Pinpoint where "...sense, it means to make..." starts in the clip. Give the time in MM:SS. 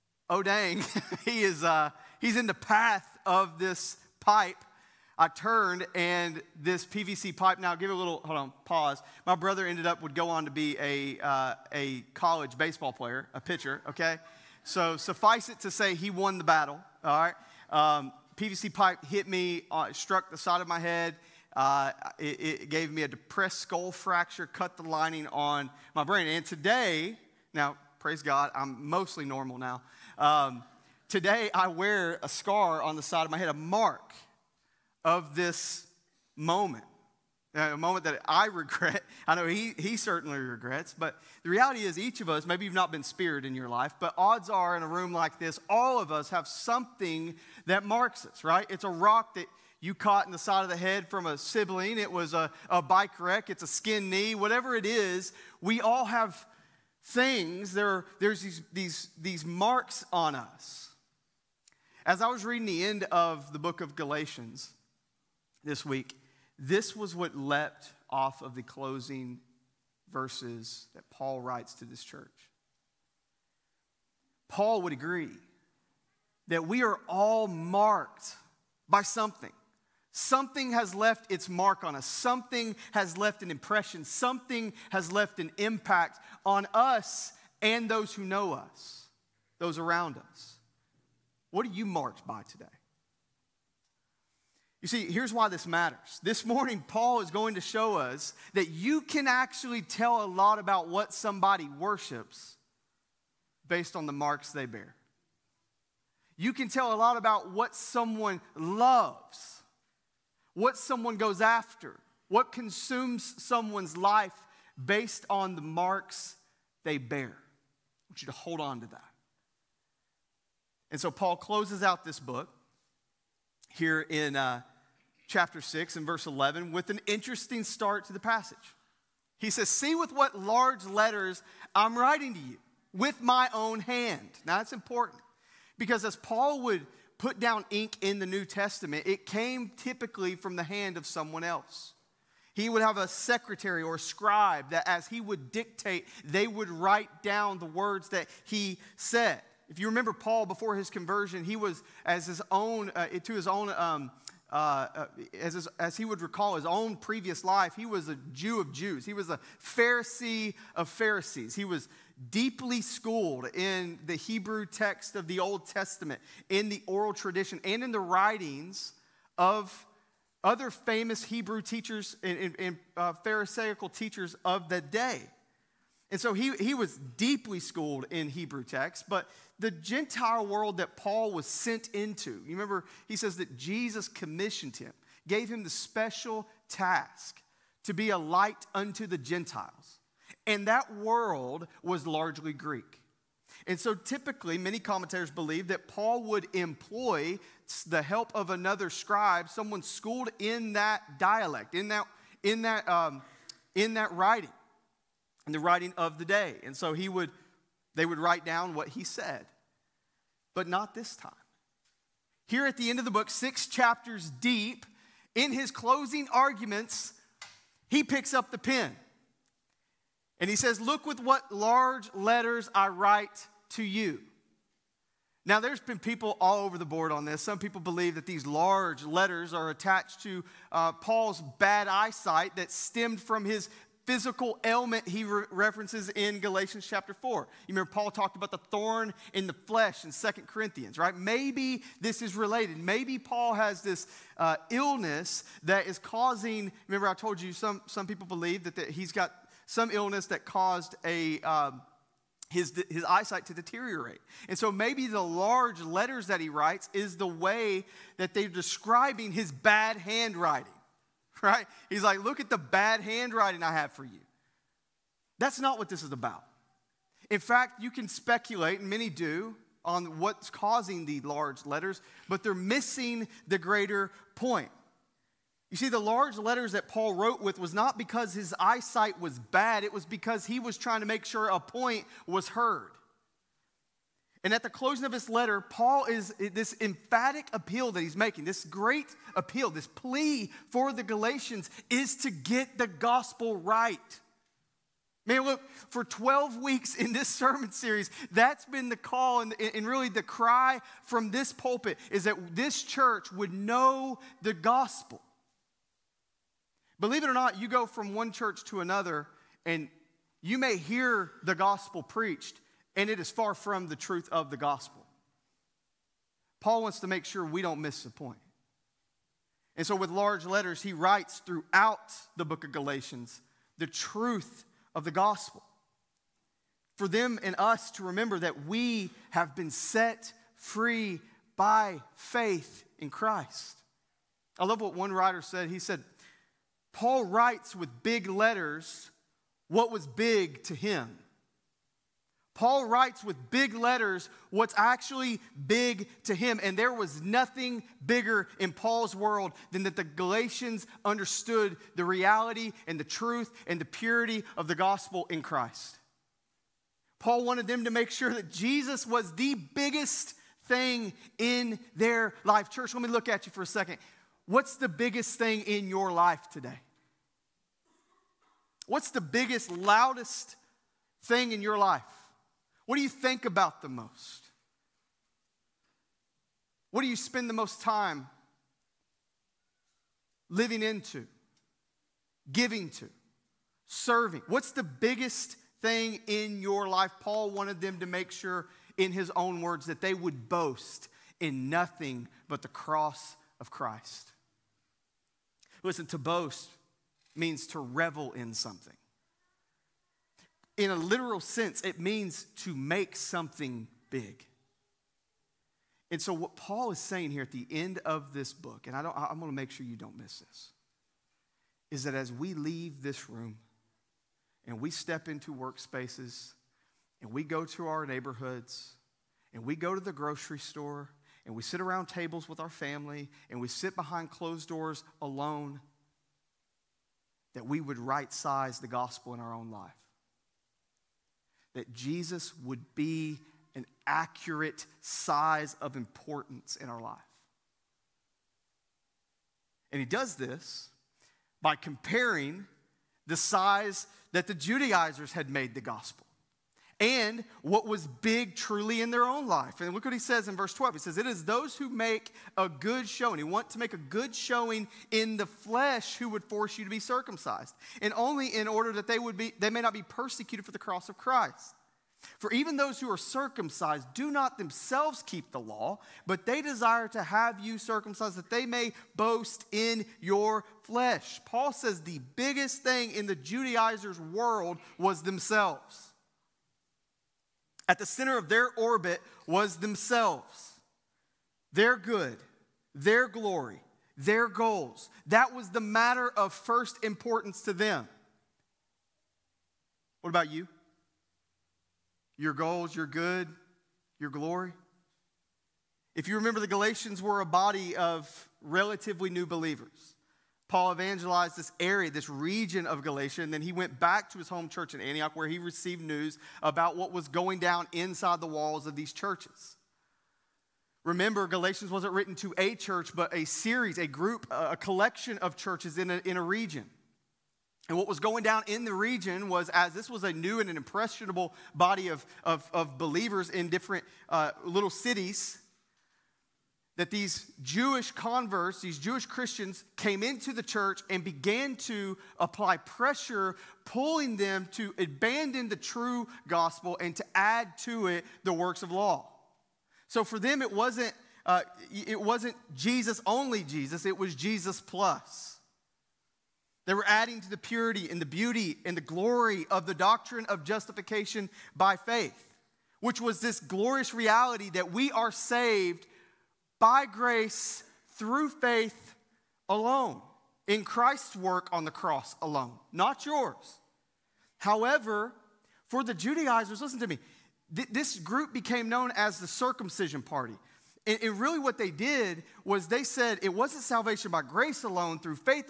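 06:41.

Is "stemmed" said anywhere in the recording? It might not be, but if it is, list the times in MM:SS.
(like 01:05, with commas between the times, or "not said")
03:52.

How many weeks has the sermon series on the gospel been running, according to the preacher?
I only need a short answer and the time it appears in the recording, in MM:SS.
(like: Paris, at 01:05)
12, at 04:56.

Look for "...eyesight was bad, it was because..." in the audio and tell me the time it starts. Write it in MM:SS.
04:38.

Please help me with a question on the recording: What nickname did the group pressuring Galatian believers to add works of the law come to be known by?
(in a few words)
Circumcision party.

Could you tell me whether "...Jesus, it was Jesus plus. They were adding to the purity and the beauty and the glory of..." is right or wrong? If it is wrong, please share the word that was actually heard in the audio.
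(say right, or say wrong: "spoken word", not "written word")
right.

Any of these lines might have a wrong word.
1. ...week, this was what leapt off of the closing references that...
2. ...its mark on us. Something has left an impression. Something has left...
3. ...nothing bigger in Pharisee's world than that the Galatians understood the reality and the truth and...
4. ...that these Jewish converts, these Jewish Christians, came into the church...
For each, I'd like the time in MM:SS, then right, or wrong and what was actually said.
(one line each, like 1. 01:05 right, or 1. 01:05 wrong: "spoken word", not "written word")
1. 01:05 wrong: "verses", not "references"
2. 01:21 right
3. 05:47 wrong: "Paul", not "Pharisee"
4. 08:46 right.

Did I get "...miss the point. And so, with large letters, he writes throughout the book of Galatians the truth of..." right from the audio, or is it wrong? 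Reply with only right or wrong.
right.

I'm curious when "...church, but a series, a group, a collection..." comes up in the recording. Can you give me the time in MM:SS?
08:32.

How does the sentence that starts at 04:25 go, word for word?
That's not what this is about.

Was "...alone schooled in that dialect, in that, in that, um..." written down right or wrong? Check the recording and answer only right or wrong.
wrong.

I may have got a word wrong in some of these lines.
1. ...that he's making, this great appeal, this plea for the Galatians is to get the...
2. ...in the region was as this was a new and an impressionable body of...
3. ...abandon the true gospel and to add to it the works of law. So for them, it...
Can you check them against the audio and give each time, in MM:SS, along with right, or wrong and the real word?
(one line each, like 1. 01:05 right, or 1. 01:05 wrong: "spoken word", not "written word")
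1. 04:47 right
2. 08:38 right
3. 08:54 right.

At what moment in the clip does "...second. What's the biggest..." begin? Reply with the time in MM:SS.
06:03.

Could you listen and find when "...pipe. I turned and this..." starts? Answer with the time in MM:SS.
00:04.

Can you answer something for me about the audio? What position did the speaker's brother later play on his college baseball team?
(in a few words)
Pitcher.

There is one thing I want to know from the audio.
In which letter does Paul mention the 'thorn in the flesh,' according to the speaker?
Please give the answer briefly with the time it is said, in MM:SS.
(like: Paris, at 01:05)
Second Corinthians, at 04:00.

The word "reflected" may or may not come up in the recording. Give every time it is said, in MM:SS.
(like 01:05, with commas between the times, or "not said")
not said.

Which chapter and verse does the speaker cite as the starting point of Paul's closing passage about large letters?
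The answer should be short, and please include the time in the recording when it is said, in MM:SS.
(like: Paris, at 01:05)
Chapter 6, verse 11, at 02:05.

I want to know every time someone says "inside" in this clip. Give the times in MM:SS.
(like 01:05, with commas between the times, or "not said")
08:27.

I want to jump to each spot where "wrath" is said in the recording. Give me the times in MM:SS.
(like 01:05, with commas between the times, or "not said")
not said.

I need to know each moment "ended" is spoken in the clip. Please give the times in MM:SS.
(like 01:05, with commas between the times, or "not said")
00:09.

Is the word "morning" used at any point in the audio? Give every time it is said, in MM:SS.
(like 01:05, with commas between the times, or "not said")
01:36.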